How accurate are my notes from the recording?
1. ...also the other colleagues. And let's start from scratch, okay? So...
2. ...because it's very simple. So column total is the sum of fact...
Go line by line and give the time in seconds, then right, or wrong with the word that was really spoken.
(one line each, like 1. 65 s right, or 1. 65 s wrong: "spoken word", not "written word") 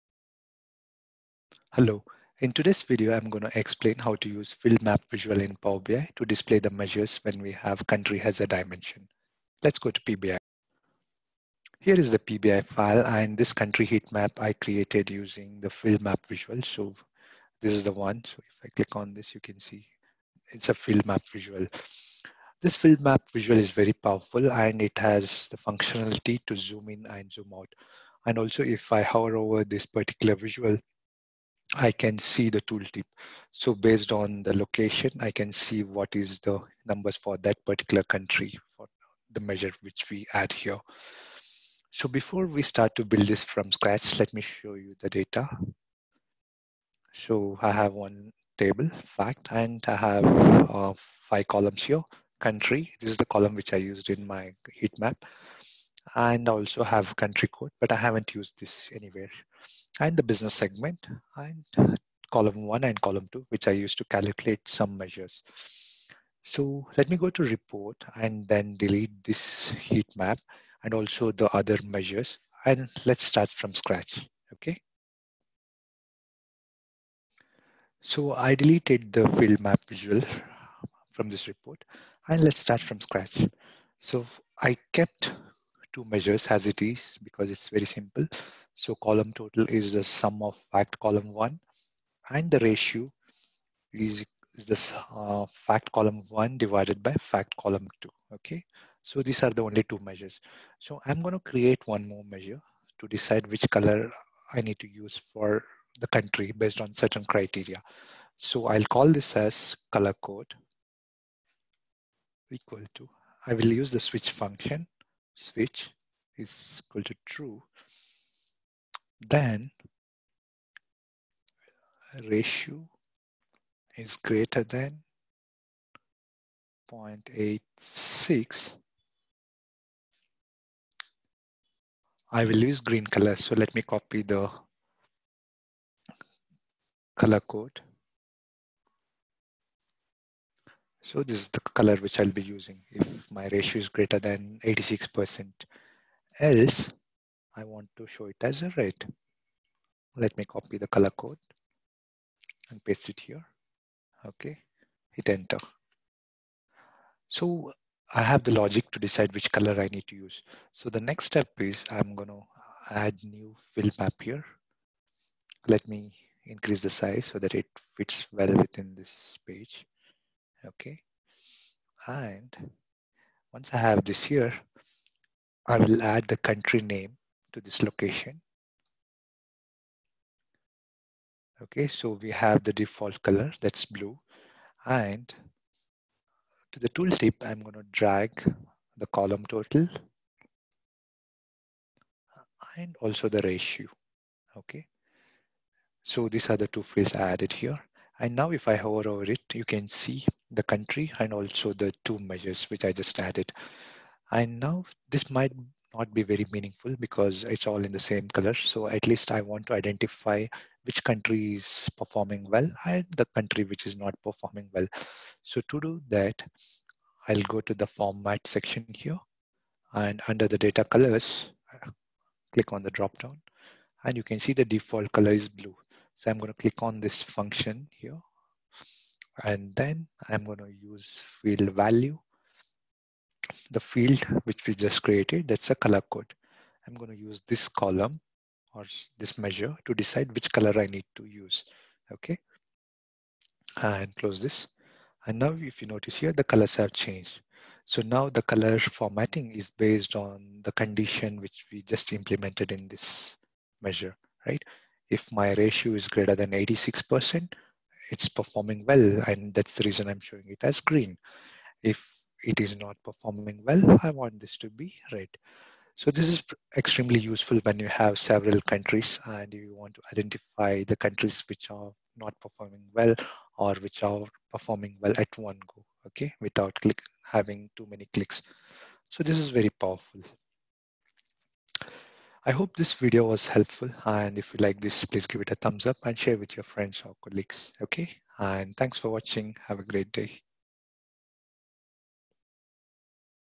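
1. 70 s wrong: "measures", not "colleagues"
2. 87 s right.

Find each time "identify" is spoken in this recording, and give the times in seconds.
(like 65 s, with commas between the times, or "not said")
209 s, 270 s.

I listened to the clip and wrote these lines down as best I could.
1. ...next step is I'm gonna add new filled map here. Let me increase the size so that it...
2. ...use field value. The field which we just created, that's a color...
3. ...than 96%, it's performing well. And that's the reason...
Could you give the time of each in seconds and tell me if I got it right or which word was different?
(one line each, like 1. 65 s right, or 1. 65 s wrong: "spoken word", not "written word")
1. 161 s right
2. 230 s right
3. 256 s wrong: "86", not "96".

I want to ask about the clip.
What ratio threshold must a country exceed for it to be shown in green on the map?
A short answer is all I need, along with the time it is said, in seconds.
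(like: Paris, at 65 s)
0.86, at 126 s.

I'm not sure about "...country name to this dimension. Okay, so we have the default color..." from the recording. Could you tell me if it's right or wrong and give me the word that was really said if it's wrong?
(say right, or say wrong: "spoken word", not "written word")
wrong: "location", not "dimension".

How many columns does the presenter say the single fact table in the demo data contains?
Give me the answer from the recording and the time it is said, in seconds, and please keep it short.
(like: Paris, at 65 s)
5, at 50 s.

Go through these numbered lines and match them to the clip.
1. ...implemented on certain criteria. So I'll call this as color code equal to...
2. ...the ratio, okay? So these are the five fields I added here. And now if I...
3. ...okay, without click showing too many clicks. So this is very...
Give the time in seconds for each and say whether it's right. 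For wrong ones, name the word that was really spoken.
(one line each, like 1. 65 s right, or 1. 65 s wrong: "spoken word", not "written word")
1. 106 s wrong: "based", not "implemented"
2. 193 s wrong: "two", not "five"
3. 276 s wrong: "having", not "showing".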